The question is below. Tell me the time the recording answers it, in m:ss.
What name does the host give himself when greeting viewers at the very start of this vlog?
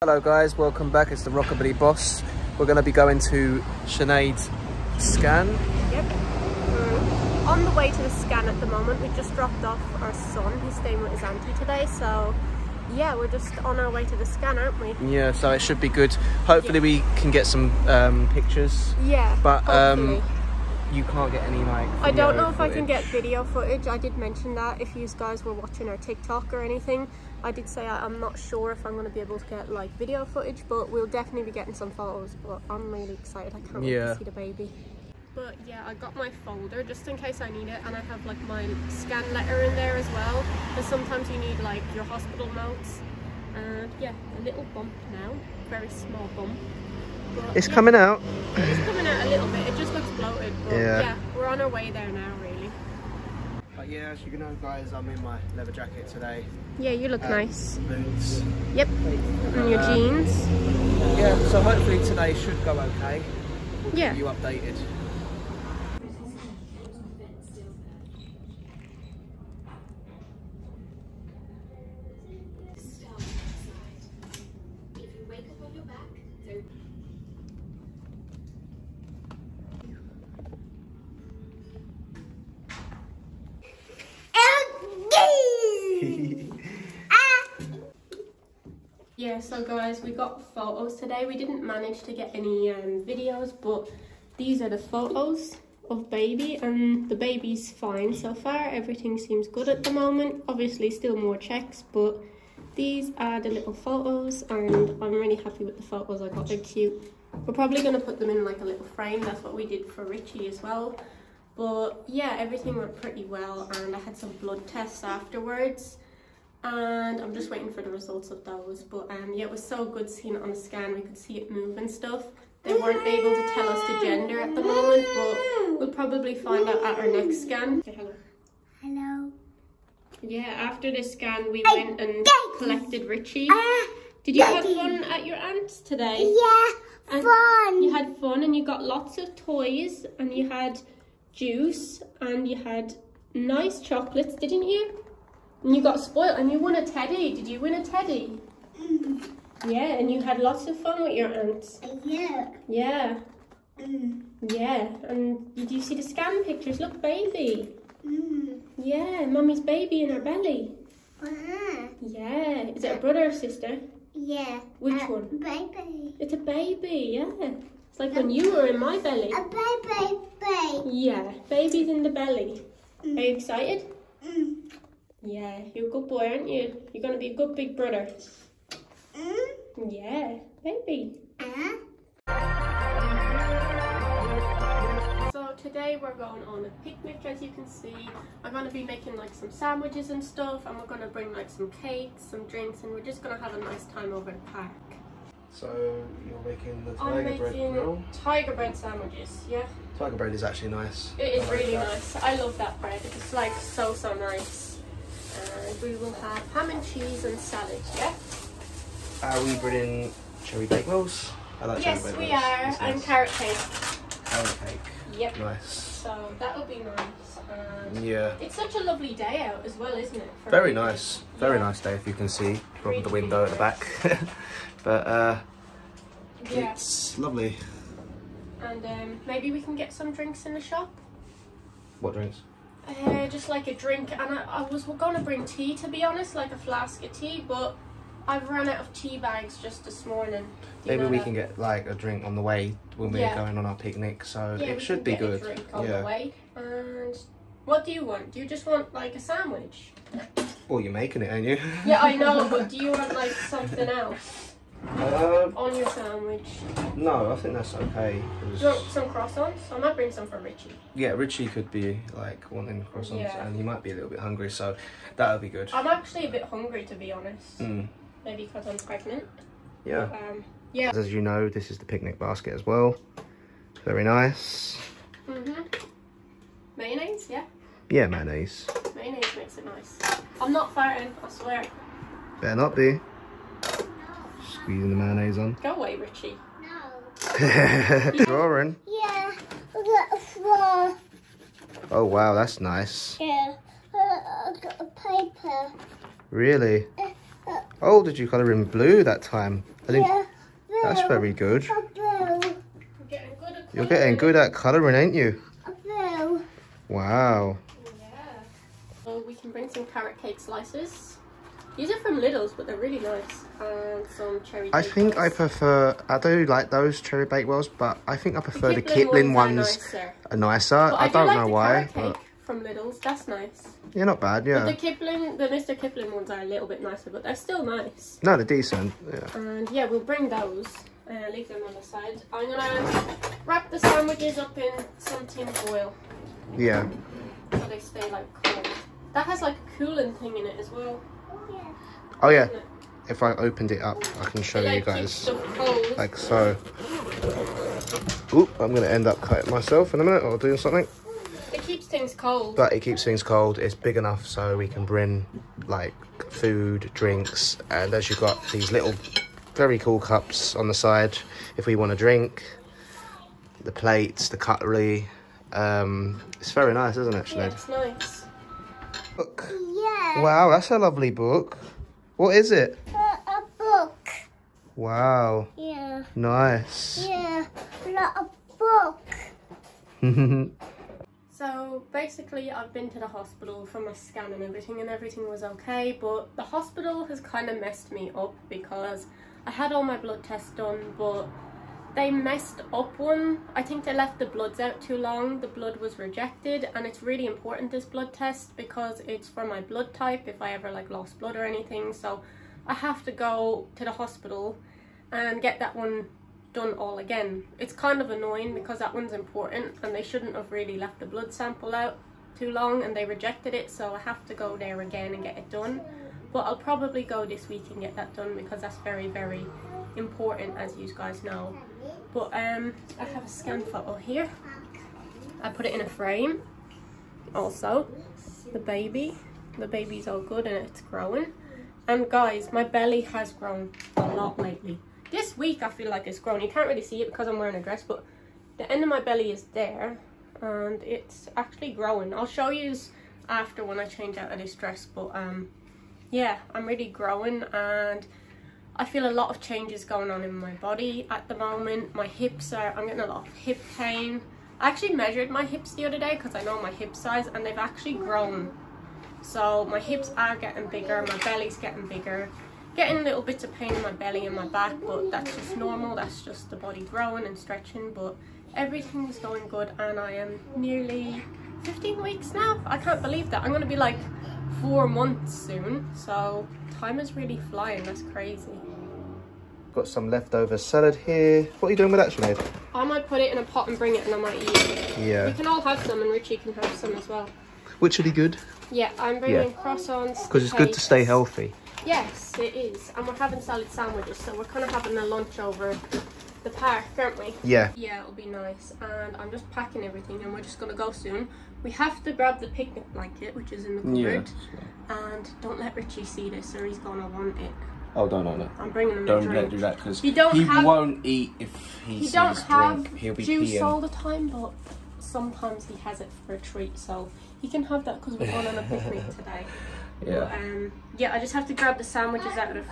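0:01.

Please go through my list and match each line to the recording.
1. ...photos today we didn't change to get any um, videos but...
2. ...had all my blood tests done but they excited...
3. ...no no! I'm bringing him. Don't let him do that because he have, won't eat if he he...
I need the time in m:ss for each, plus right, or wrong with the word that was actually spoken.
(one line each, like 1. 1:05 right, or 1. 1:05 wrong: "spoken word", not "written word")
1. 1:30 wrong: "manage", not "change"
2. 6:29 wrong: "messed", not "excited"
3. 8:28 right.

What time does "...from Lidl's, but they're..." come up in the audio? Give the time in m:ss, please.
5:11.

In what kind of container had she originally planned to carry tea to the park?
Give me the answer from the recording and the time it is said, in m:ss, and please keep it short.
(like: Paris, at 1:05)
A flask, at 3:56.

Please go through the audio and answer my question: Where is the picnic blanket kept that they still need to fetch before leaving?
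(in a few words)
The cupboard.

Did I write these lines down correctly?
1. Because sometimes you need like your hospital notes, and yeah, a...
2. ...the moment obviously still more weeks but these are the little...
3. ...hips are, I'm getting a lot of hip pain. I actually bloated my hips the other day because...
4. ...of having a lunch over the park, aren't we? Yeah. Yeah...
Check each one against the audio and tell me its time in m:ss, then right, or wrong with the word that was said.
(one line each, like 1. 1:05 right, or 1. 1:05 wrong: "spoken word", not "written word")
1. 0:40 right
2. 1:39 wrong: "checks", not "weeks"
3. 7:32 wrong: "measured", not "bloated"
4. 8:14 right.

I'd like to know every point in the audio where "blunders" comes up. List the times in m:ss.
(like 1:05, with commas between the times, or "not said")
not said.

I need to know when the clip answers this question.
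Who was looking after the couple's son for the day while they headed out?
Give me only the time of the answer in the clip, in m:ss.
0:11.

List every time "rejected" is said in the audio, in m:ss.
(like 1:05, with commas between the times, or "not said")
6:35, 6:53.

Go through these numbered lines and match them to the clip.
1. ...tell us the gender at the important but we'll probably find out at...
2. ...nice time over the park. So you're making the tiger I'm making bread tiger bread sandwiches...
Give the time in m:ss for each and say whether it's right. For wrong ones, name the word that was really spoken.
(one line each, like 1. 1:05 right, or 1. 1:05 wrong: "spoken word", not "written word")
1. 2:03 wrong: "moment", not "important"
2. 3:13 right.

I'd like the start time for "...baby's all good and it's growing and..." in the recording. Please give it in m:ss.
7:09.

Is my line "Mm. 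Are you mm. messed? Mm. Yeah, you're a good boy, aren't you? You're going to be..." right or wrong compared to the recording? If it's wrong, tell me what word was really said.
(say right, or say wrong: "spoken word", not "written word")
wrong: "excited", not "messed".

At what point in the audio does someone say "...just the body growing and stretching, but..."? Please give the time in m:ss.
7:46.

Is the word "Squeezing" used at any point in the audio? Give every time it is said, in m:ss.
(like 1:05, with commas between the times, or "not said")
4:44.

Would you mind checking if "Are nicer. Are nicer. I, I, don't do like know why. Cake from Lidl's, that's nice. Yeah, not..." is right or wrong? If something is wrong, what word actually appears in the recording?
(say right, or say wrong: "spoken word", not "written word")
right.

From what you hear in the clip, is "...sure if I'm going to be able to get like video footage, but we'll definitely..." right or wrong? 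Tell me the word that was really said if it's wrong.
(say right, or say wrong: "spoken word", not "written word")
right.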